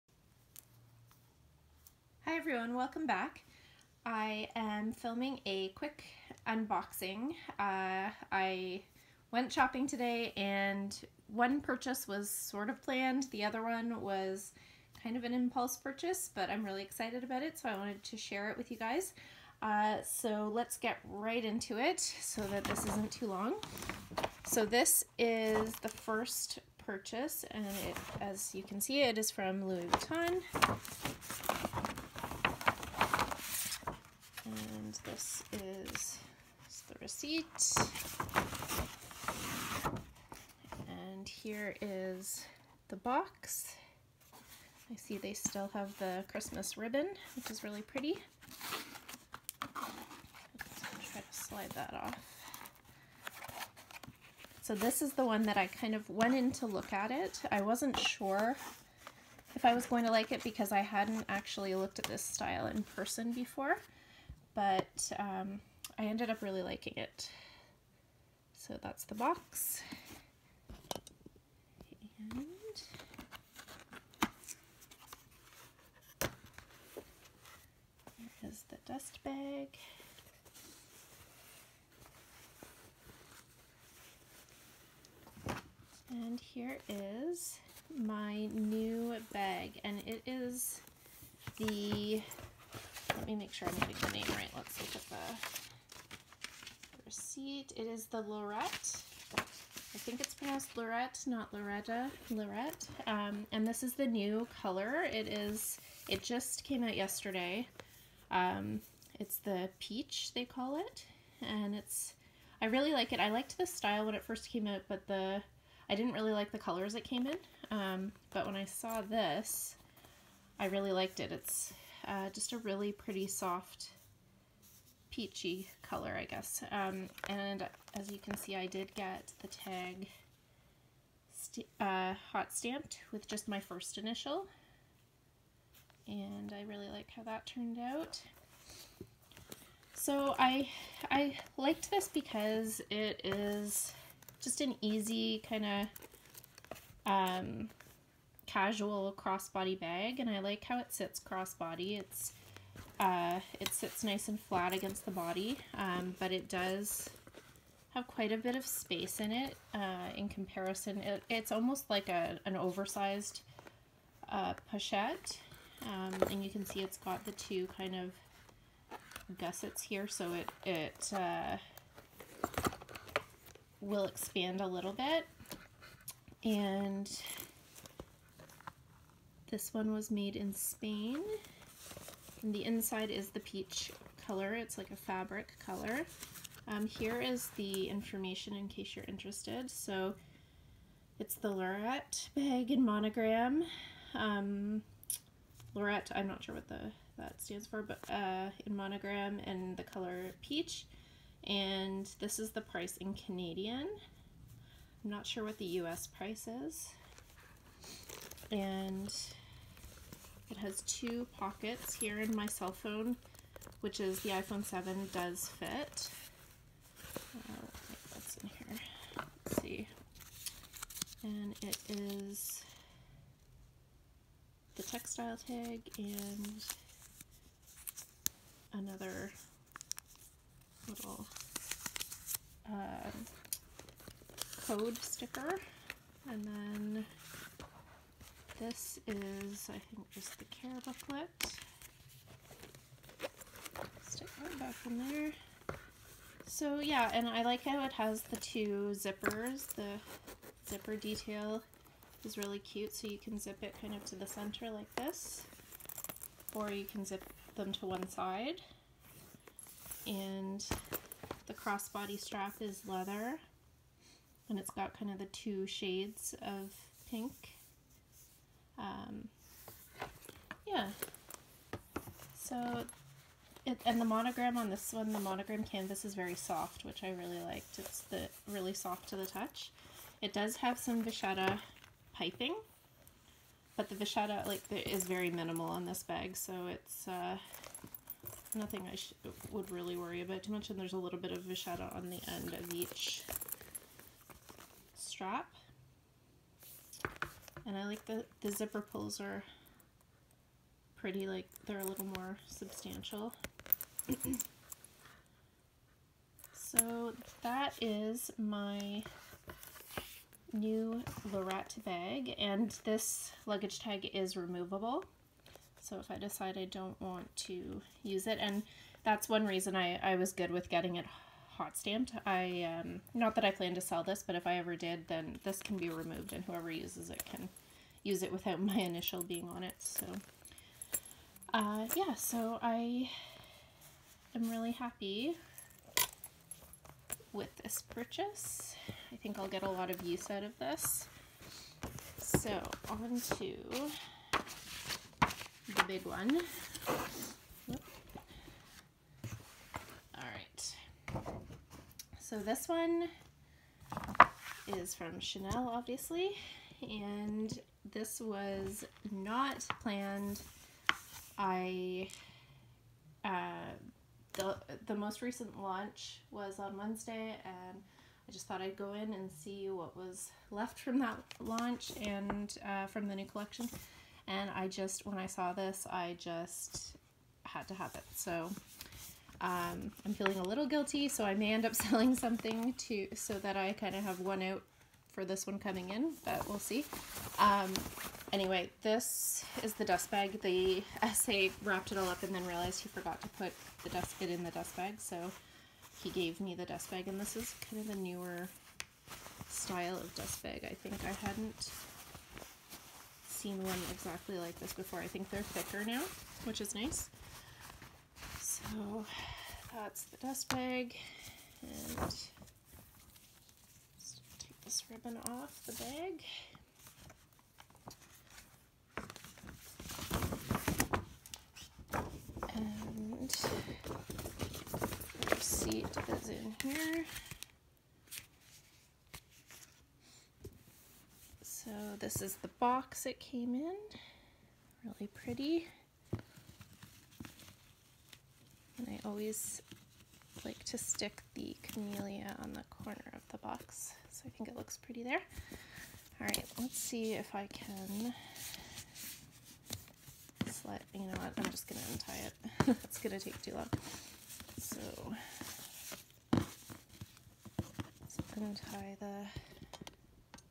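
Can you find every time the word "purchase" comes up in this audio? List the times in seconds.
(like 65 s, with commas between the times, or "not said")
11 s, 15 s, 26 s, 337 s.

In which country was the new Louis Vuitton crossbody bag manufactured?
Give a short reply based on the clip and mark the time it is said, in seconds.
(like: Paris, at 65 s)
Spain, at 180 s.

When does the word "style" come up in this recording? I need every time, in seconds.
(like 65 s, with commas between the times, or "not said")
62 s, 113 s, 399 s.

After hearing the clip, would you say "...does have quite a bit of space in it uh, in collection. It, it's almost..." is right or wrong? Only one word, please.
wrong.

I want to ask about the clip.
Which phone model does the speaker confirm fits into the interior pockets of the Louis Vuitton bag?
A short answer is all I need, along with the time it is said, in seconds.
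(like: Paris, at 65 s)
iPhone 7, at 214 s.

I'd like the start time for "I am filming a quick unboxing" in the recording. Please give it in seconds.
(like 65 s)
4 s.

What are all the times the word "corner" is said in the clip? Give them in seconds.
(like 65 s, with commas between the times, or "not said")
442 s.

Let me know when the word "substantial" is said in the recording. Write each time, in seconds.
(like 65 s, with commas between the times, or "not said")
302 s.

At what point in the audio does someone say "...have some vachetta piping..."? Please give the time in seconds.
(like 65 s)
280 s.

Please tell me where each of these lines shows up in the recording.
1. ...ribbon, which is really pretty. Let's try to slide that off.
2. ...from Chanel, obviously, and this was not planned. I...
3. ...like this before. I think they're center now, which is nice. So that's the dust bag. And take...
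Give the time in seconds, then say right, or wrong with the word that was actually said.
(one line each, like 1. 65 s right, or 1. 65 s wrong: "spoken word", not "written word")
1. 46 s right
2. 354 s right
3. 404 s wrong: "thicker", not "center".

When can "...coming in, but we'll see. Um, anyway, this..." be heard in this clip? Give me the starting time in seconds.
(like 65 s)
385 s.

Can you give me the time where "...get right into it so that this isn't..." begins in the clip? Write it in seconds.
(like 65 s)
20 s.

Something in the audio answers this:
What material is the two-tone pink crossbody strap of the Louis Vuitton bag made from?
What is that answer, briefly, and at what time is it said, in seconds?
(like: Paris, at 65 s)
Leather, at 262 s.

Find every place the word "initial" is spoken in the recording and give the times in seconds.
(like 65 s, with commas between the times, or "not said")
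133 s, 328 s.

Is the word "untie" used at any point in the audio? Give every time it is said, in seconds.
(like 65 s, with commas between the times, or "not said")
451 s, 458 s.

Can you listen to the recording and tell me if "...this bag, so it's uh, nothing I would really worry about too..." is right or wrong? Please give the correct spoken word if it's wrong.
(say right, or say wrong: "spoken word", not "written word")
right.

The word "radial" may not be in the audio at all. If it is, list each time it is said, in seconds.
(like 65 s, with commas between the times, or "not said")
not said.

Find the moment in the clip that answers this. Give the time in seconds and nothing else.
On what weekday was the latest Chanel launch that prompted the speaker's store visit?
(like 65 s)
366 s.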